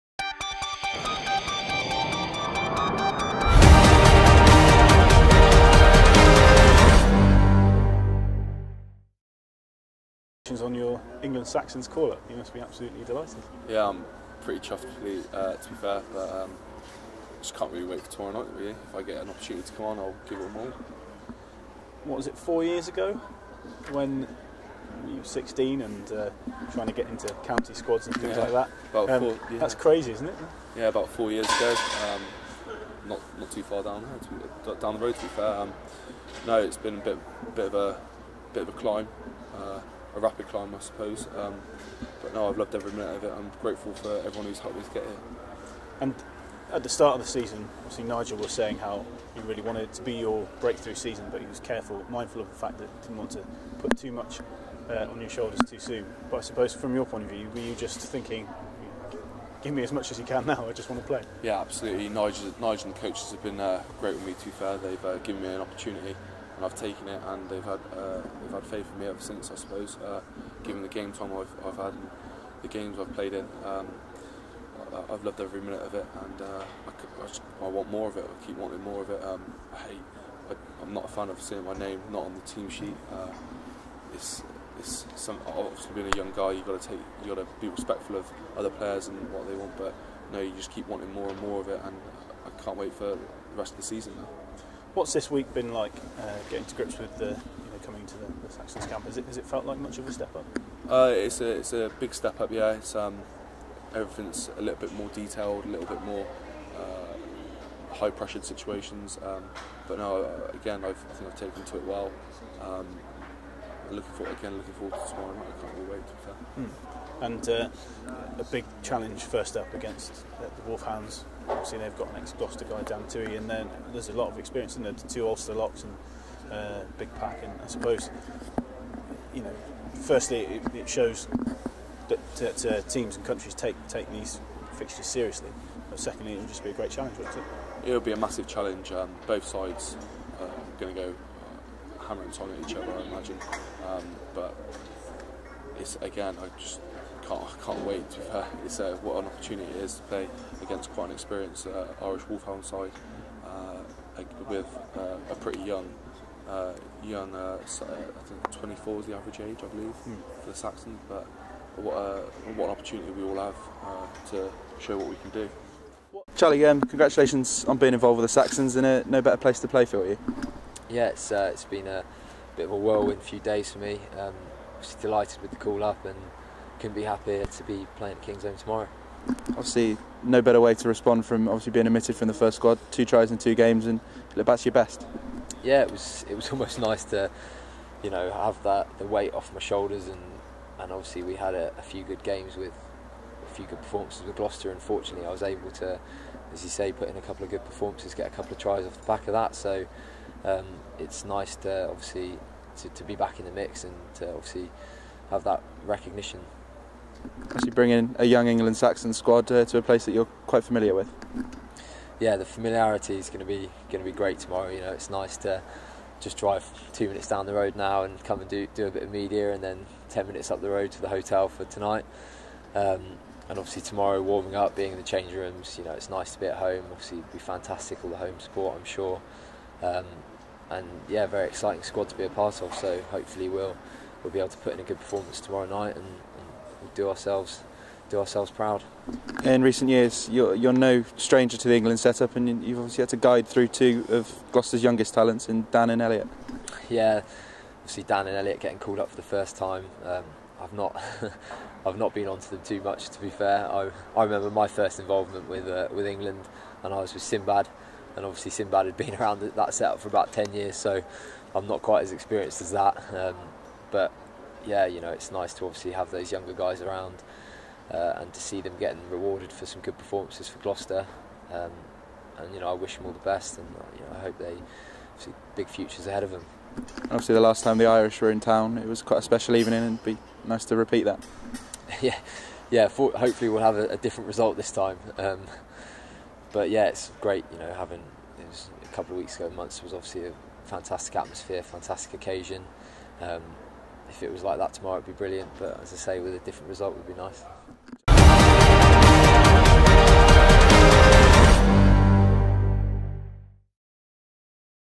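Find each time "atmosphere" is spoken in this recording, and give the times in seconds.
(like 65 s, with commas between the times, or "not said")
291 s.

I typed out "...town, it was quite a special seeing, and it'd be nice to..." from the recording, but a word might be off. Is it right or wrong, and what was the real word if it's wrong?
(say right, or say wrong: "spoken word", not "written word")
wrong: "evening", not "seeing".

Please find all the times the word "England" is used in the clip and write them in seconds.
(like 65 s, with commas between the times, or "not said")
11 s, 208 s, 241 s, 256 s.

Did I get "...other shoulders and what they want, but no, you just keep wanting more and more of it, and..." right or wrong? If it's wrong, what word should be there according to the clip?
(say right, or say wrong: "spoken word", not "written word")
wrong: "players", not "shoulders".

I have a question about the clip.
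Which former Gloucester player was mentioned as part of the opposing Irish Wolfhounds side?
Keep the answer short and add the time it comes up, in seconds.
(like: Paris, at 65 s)
Dan Tuohy, at 122 s.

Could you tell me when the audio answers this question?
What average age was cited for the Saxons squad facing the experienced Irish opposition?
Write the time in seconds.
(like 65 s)
158 s.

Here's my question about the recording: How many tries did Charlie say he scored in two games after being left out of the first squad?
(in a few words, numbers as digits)
2.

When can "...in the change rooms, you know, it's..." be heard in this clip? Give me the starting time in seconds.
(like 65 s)
224 s.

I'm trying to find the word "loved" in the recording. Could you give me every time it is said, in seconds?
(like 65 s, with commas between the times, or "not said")
42 s, 75 s.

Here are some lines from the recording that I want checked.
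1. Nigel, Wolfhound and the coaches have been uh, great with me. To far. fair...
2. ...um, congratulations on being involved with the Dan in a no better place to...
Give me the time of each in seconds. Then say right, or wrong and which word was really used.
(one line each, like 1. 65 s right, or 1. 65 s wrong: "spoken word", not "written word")
1. 62 s wrong: "Nigel", not "Wolfhound"
2. 166 s wrong: "Saxons", not "Dan".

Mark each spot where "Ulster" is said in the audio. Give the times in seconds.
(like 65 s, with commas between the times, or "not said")
125 s.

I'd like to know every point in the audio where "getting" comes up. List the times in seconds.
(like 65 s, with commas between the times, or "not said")
96 s, 248 s, 268 s.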